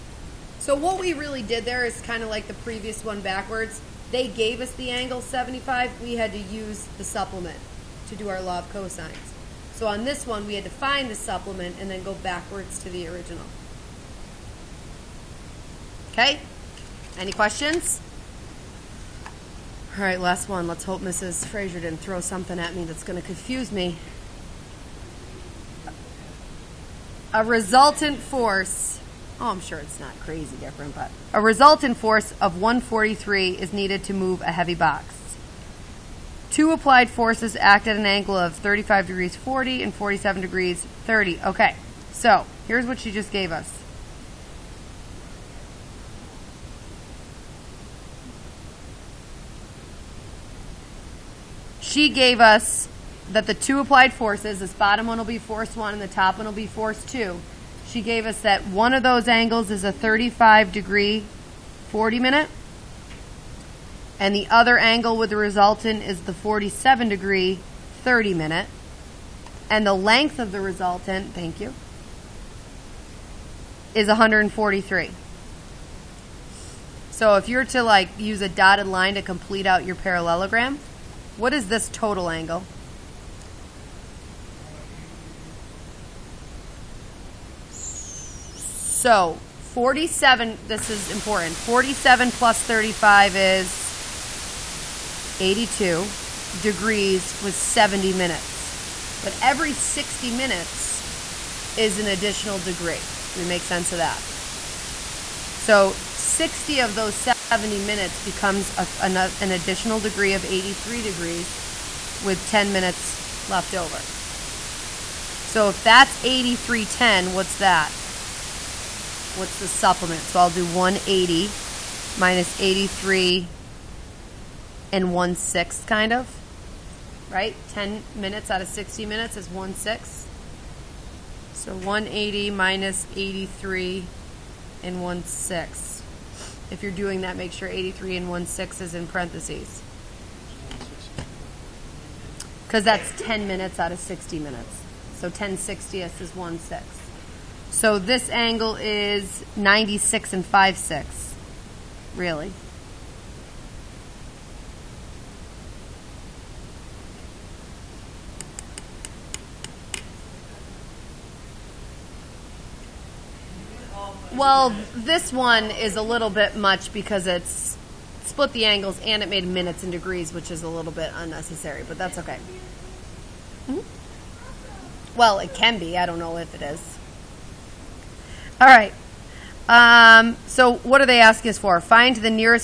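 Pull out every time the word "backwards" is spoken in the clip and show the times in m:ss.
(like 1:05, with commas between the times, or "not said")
0:03, 0:12.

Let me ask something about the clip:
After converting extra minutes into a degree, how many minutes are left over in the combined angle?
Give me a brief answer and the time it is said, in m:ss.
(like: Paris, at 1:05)
10, at 1:52.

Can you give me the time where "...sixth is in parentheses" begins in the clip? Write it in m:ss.
2:18.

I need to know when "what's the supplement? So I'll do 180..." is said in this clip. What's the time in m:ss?
1:59.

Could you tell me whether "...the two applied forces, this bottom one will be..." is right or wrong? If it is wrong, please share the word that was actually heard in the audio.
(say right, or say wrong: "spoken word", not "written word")
right.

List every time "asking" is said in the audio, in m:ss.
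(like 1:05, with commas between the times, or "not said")
3:01.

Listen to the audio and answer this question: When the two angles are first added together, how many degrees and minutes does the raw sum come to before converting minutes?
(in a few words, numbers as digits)
82 degrees 70 minutes.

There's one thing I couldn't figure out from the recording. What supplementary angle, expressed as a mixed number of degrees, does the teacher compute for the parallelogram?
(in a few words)
96 and 5/6.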